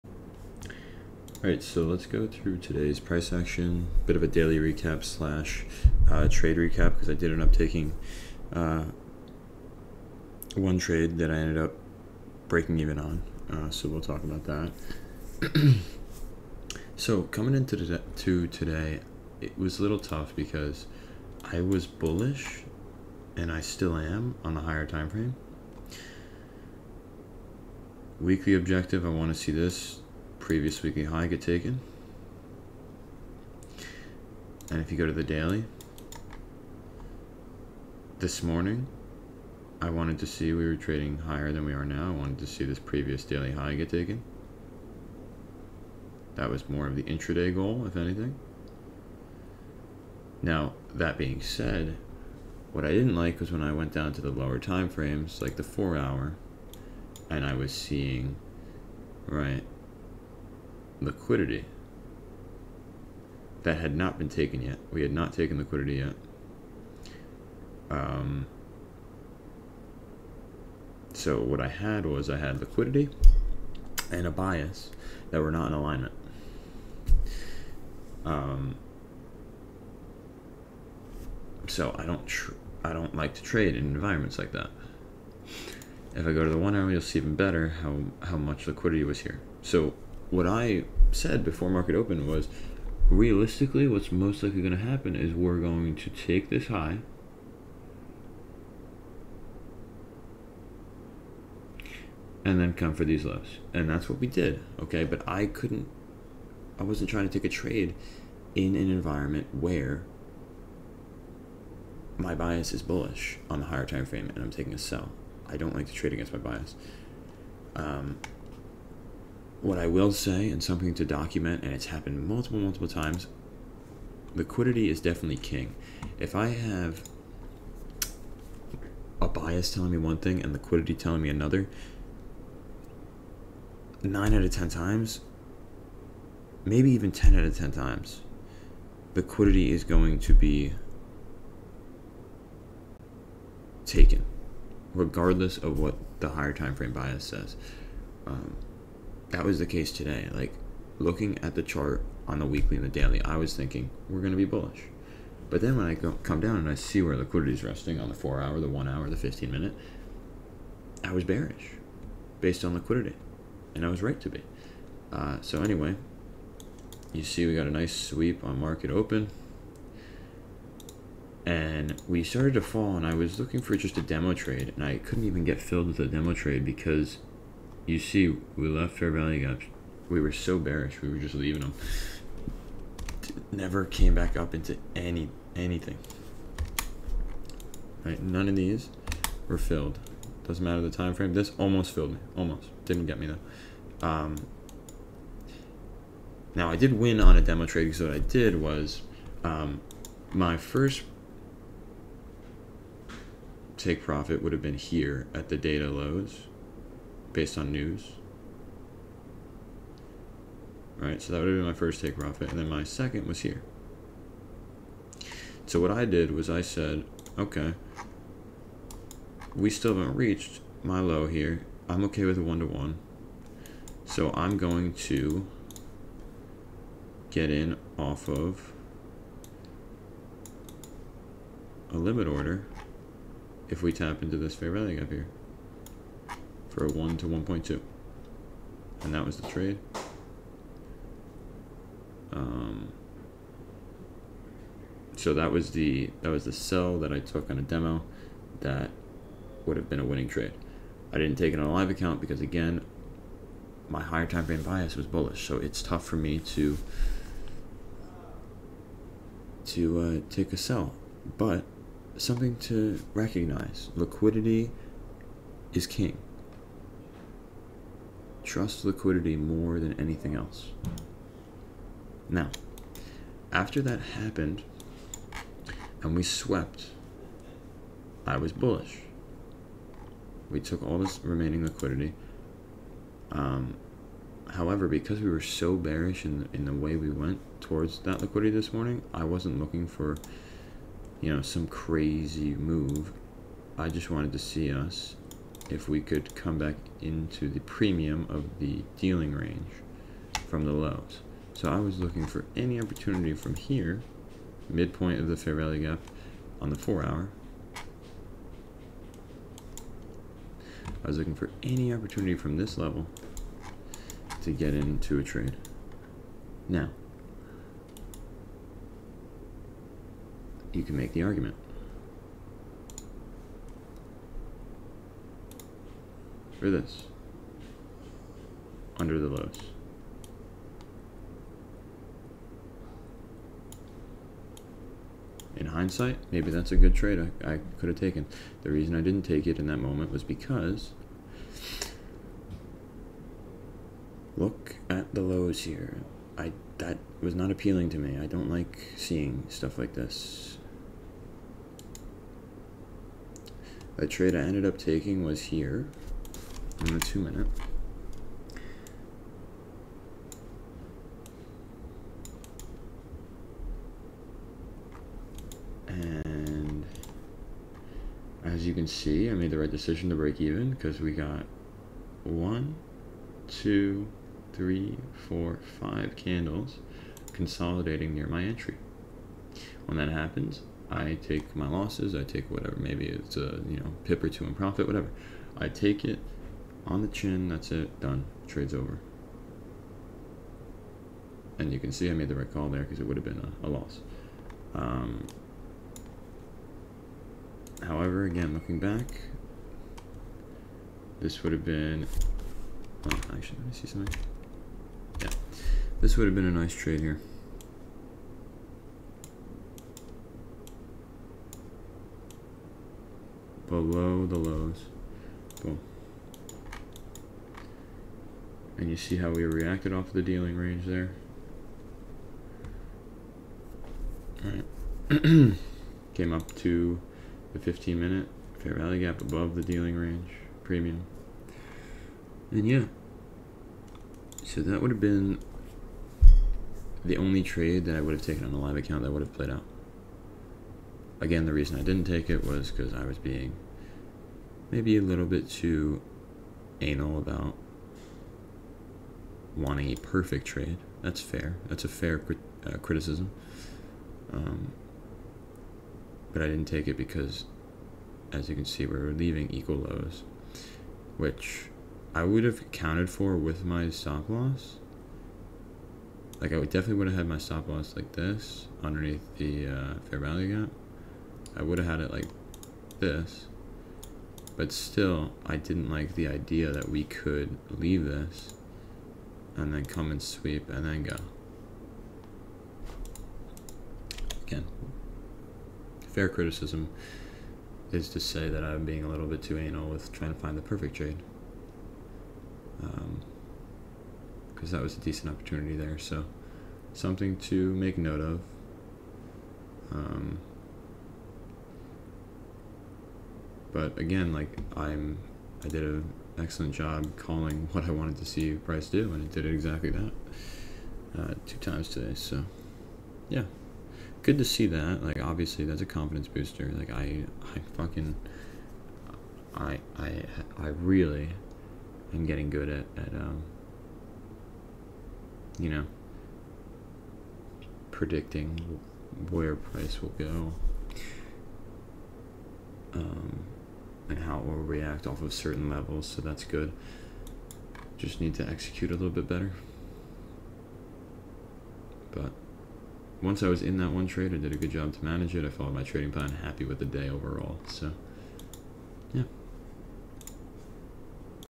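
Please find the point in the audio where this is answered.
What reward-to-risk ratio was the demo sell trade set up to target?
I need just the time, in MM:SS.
03:56.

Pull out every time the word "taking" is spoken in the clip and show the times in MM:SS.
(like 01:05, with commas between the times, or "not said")
00:07, 01:54, 05:54.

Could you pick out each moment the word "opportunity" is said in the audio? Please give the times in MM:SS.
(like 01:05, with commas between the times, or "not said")
05:02, 05:11, 08:15.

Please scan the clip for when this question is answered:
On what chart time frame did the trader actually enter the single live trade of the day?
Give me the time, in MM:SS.
05:56.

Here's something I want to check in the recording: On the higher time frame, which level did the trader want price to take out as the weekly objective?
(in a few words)
previous weekly high.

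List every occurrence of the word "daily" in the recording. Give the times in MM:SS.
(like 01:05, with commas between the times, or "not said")
00:04, 00:35, 00:43, 02:32.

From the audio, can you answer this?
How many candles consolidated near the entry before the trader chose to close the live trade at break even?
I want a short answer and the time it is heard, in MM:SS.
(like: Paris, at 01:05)
5, at 06:15.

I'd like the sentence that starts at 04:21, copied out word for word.
But something to recognize: liquidity is king trust liquidity more than anything else.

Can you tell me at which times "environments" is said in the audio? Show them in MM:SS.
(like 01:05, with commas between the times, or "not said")
01:23, 01:48.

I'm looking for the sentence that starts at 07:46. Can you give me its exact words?
Like I would definitely would have had my stop loss like this underneath the uh, fair value gap.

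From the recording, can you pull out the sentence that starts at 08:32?
So, yeah, good to see that.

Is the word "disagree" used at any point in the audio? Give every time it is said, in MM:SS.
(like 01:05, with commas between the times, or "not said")
not said.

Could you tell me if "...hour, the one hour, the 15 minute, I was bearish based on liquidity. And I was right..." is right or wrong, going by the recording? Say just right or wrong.
right.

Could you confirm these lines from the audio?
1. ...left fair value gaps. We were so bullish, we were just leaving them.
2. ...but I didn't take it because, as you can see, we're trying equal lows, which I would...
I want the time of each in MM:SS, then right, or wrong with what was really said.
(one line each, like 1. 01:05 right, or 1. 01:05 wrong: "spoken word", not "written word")
1. 02:58 wrong: "bearish", not "bullish"
2. 07:36 wrong: "leaving", not "trying".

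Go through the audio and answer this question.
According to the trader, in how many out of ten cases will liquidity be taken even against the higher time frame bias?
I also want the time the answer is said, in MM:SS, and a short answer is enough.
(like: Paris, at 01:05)
9, at 02:14.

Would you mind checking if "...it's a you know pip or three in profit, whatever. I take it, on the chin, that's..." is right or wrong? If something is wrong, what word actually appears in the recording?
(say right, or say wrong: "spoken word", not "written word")
wrong: "two", not "three".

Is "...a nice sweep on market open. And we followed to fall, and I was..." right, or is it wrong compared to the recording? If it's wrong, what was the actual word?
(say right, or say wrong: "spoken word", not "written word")
wrong: "started", not "followed".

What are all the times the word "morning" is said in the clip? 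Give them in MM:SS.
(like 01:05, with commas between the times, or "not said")
00:38, 04:48.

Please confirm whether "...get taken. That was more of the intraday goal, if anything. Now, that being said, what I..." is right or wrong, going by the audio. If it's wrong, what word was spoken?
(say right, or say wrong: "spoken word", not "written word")
right.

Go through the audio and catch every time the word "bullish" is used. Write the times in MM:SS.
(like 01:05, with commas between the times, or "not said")
00:21, 01:52, 02:34, 04:15, 04:38.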